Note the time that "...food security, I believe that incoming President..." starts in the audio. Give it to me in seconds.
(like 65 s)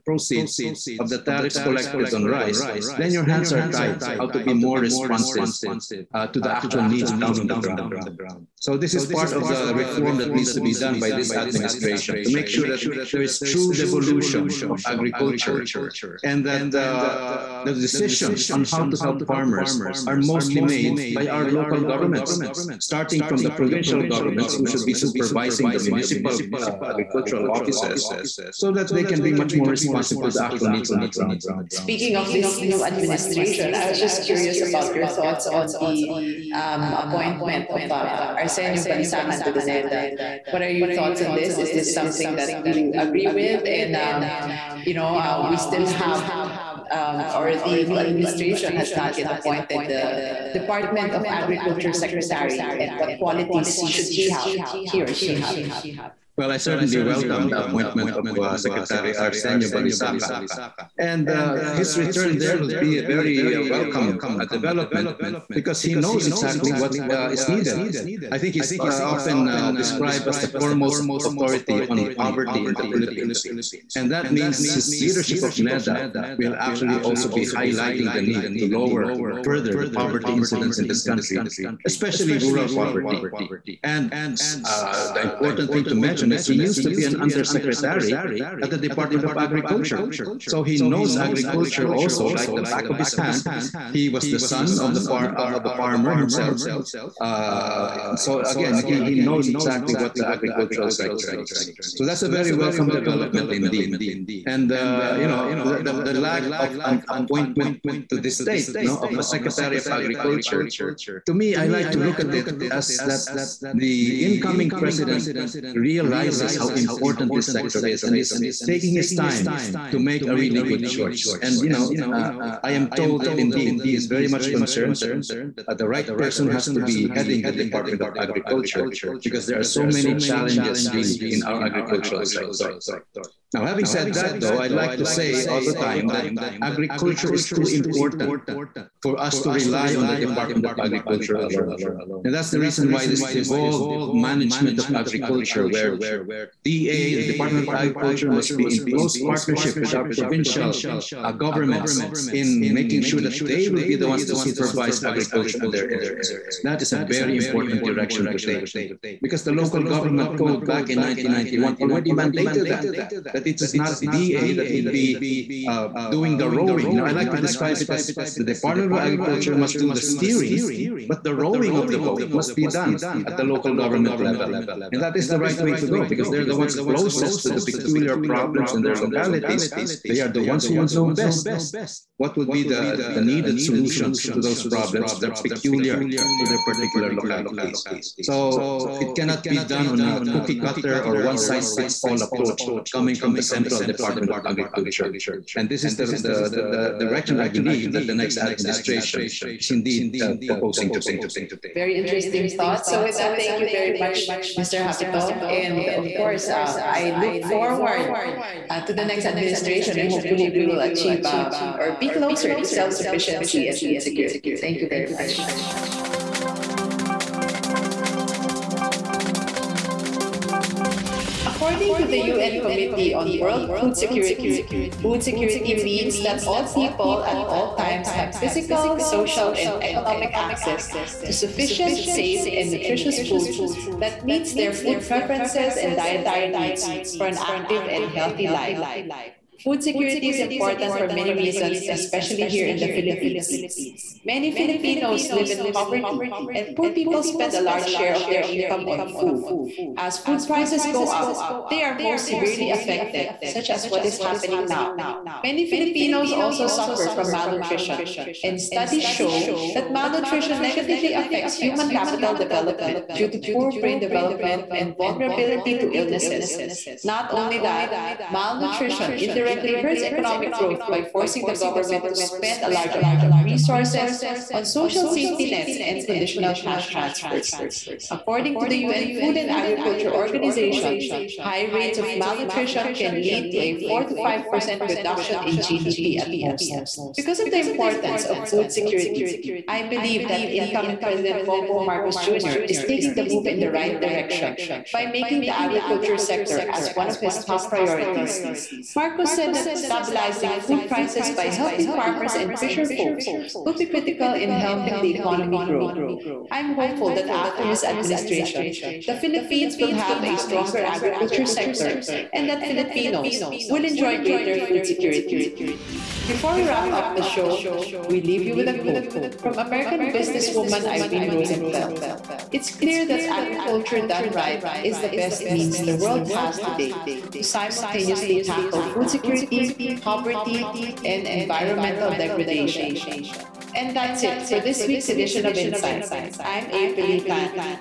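288 s.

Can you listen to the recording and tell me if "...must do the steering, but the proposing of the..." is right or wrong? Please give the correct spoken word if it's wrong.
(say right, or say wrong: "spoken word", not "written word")
wrong: "rowing", not "proposing".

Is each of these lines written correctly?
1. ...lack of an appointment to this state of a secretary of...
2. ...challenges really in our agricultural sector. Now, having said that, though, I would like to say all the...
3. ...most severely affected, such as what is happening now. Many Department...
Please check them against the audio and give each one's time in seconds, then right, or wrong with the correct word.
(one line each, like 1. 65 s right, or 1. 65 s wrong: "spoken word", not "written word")
1. 106 s right
2. 130 s right
3. 252 s wrong: "Filipinos", not "Department".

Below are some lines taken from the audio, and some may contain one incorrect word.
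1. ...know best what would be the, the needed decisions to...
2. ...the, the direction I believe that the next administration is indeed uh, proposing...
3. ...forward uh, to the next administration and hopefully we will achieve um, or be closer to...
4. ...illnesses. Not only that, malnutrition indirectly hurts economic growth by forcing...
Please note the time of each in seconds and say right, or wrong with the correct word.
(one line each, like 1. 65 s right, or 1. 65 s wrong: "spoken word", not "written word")
1. 180 s wrong: "solutions", not "decisions"
2. 196 s right
3. 207 s right
4. 265 s right.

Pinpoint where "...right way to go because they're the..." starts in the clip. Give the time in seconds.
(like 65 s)
175 s.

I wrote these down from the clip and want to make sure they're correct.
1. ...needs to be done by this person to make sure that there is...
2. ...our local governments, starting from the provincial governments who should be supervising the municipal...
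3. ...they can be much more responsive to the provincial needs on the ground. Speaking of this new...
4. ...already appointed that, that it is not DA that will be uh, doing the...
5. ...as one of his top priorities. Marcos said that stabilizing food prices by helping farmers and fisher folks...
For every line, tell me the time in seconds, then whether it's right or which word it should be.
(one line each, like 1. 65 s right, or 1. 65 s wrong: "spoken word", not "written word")
1. 10 s wrong: "administration", not "person"
2. 21 s right
3. 28 s wrong: "actual", not "provincial"
4. 161 s wrong: "mandated", not "appointed"
5. 296 s right.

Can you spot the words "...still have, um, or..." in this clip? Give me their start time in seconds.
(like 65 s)
45 s.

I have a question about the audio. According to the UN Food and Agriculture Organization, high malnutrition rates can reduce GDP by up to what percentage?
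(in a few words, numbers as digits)
4 to 5%.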